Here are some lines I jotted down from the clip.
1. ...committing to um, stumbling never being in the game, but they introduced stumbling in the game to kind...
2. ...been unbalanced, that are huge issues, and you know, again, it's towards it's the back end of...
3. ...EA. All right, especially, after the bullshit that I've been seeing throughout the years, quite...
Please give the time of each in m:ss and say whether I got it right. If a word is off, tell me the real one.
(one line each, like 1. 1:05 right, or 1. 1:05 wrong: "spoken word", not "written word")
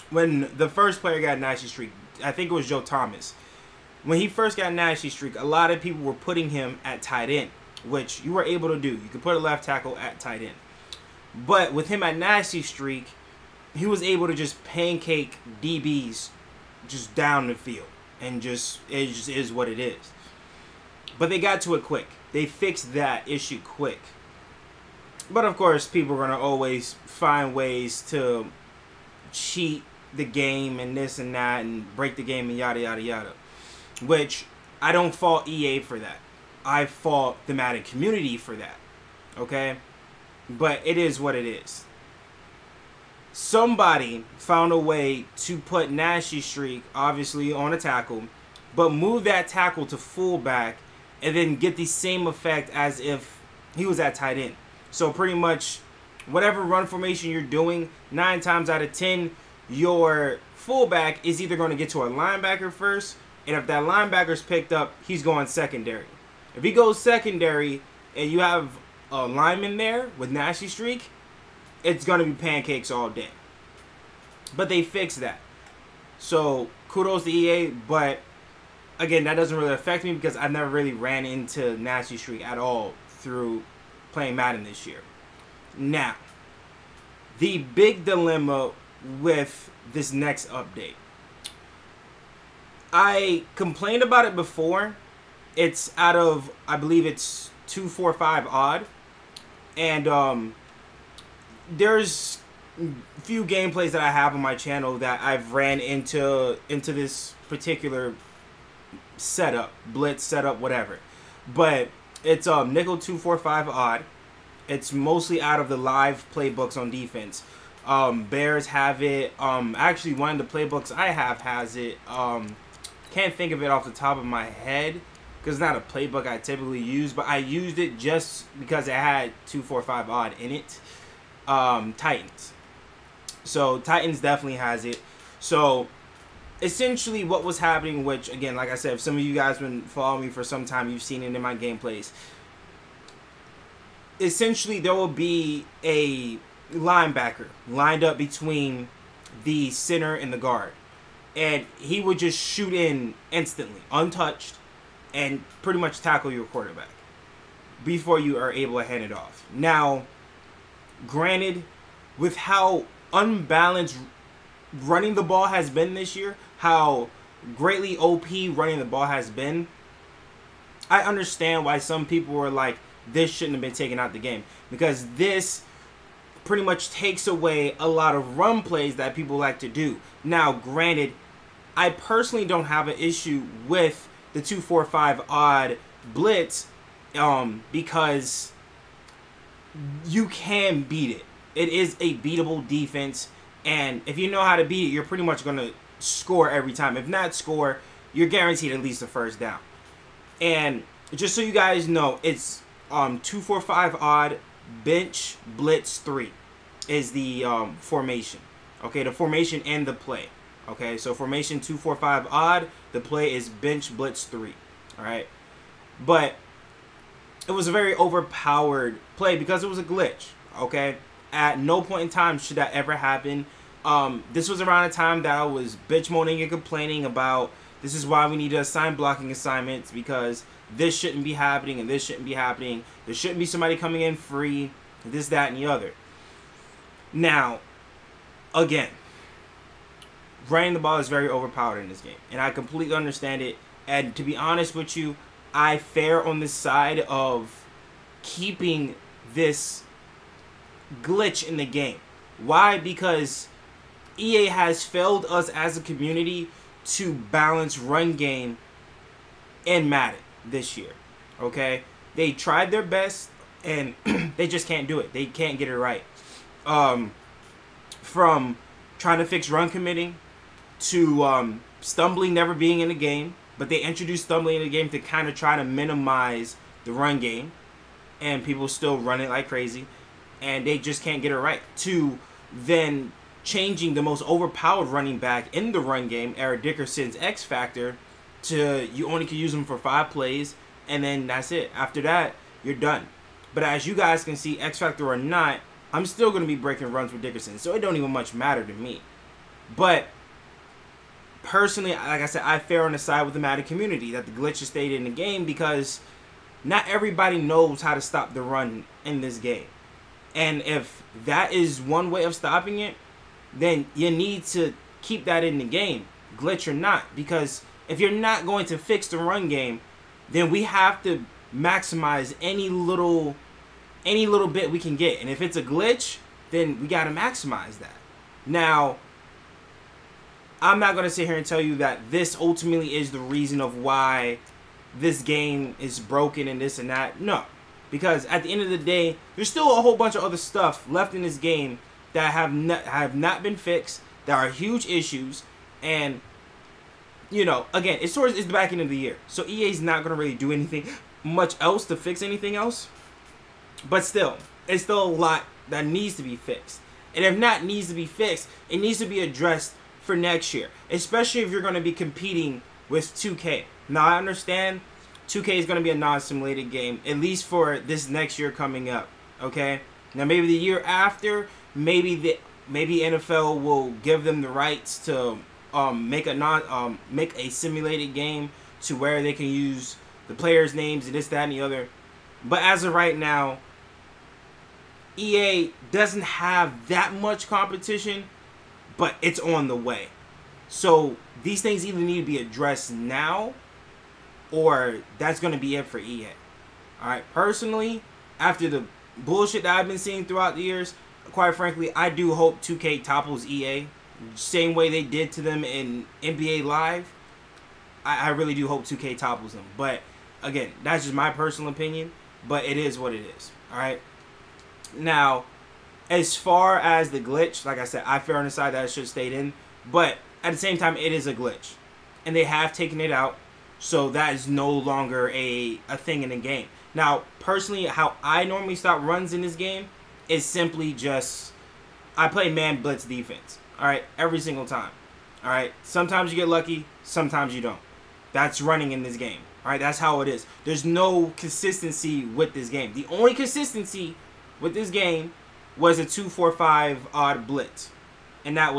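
1. 4:29 right
2. 5:43 wrong: "fixed", not "unbalanced"
3. 6:35 wrong: "personally", not "especially".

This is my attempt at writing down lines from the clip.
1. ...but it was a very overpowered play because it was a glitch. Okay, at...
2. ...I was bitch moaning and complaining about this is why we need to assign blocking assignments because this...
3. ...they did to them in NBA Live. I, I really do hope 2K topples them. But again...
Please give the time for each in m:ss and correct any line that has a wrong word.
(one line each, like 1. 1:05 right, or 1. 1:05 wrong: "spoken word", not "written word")
1. 3:36 right
2. 3:45 right
3. 6:44 right.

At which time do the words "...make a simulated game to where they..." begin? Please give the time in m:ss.
6:17.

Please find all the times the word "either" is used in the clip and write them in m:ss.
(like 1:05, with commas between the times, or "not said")
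1:01, 6:31.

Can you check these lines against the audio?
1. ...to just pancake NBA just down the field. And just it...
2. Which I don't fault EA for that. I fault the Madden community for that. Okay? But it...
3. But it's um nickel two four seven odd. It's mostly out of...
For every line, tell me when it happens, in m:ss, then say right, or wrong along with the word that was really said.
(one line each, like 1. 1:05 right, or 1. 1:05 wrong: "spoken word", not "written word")
1. 0:14 wrong: "DBs", not "NBA"
2. 0:34 right
3. 1:51 wrong: "five", not "seven".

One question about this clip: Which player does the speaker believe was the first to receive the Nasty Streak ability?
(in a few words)
Joe Thomas.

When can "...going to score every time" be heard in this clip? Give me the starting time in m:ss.
3:15.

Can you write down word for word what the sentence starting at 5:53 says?
But still, it's still a lot that needs to be fixed.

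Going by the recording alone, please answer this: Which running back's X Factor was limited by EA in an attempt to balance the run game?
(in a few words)
Eric Dickerson.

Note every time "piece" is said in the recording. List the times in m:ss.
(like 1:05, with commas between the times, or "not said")
not said.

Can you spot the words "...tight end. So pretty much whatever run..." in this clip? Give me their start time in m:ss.
0:54.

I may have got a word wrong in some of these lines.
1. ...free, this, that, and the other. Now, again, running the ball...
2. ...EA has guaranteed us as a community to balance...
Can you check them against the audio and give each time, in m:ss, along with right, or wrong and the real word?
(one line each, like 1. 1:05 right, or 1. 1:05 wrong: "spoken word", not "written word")
1. 3:54 right
2. 4:14 wrong: "failed", not "guaranteed".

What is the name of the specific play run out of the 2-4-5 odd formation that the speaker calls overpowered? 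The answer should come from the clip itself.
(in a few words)
Bench Blitz 3.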